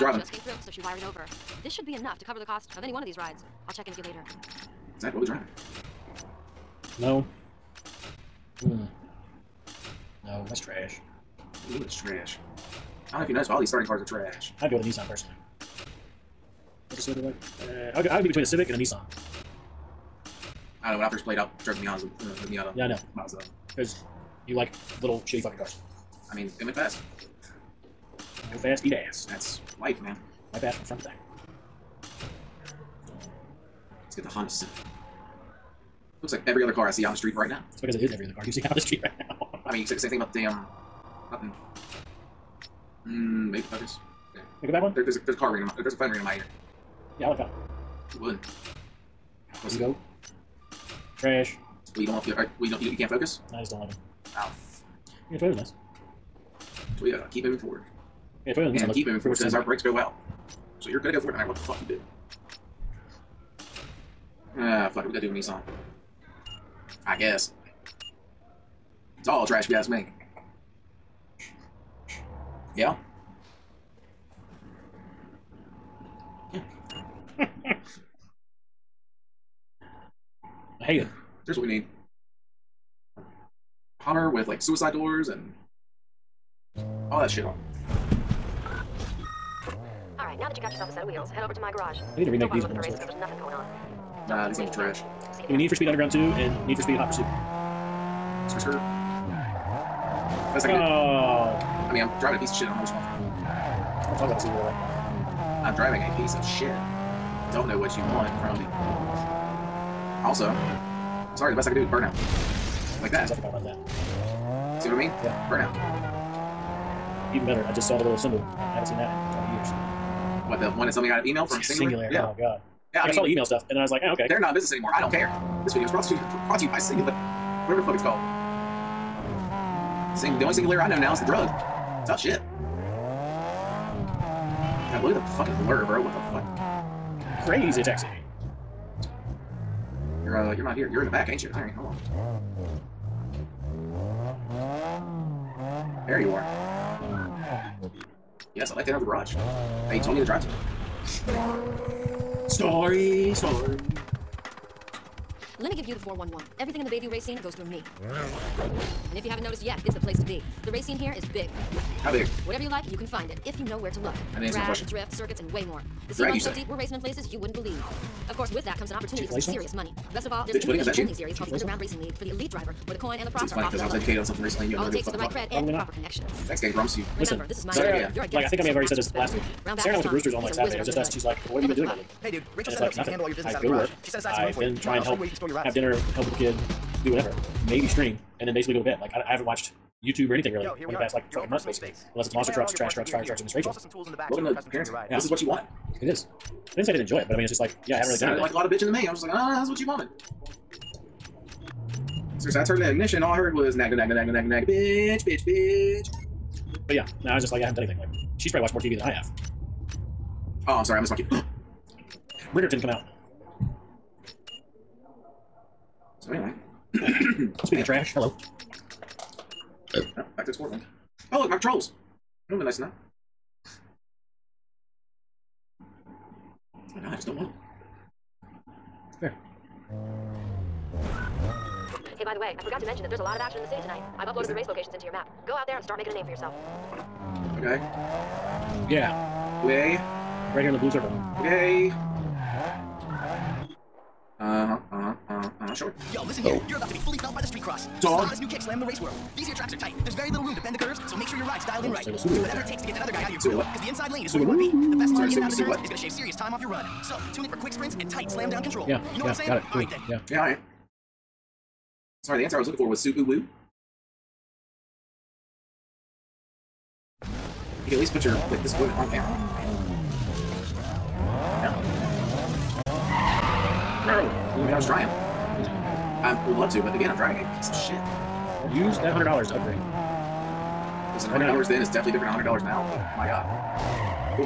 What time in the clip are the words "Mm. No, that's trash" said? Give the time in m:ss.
0:08.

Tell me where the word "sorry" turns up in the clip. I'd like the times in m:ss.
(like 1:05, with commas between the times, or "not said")
1:51, 3:30, 4:22.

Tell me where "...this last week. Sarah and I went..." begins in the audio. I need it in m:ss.
2:58.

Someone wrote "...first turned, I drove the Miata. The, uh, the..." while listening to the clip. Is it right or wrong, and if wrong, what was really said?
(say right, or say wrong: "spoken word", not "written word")
wrong: "played", not "turned".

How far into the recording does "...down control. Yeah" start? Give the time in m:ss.
4:18.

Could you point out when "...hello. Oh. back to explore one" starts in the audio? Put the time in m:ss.
3:38.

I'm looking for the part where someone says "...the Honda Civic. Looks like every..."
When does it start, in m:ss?
0:34.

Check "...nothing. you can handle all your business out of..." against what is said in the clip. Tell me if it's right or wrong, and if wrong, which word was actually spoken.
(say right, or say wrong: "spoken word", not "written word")
right.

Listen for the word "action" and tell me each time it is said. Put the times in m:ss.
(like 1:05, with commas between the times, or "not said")
3:53.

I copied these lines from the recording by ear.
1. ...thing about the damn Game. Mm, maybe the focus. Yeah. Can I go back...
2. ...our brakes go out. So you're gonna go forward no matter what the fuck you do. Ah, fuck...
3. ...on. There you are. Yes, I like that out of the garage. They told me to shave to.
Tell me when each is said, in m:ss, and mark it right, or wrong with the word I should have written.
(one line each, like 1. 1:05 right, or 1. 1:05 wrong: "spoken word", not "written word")
1. 0:40 wrong: "Nothing", not "Game"
2. 0:59 right
3. 2:21 wrong: "drive", not "shave".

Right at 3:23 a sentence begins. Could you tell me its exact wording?
All I heard was nagna, nagna, nagna, nagna, nagna, bitch, bitch, bitch.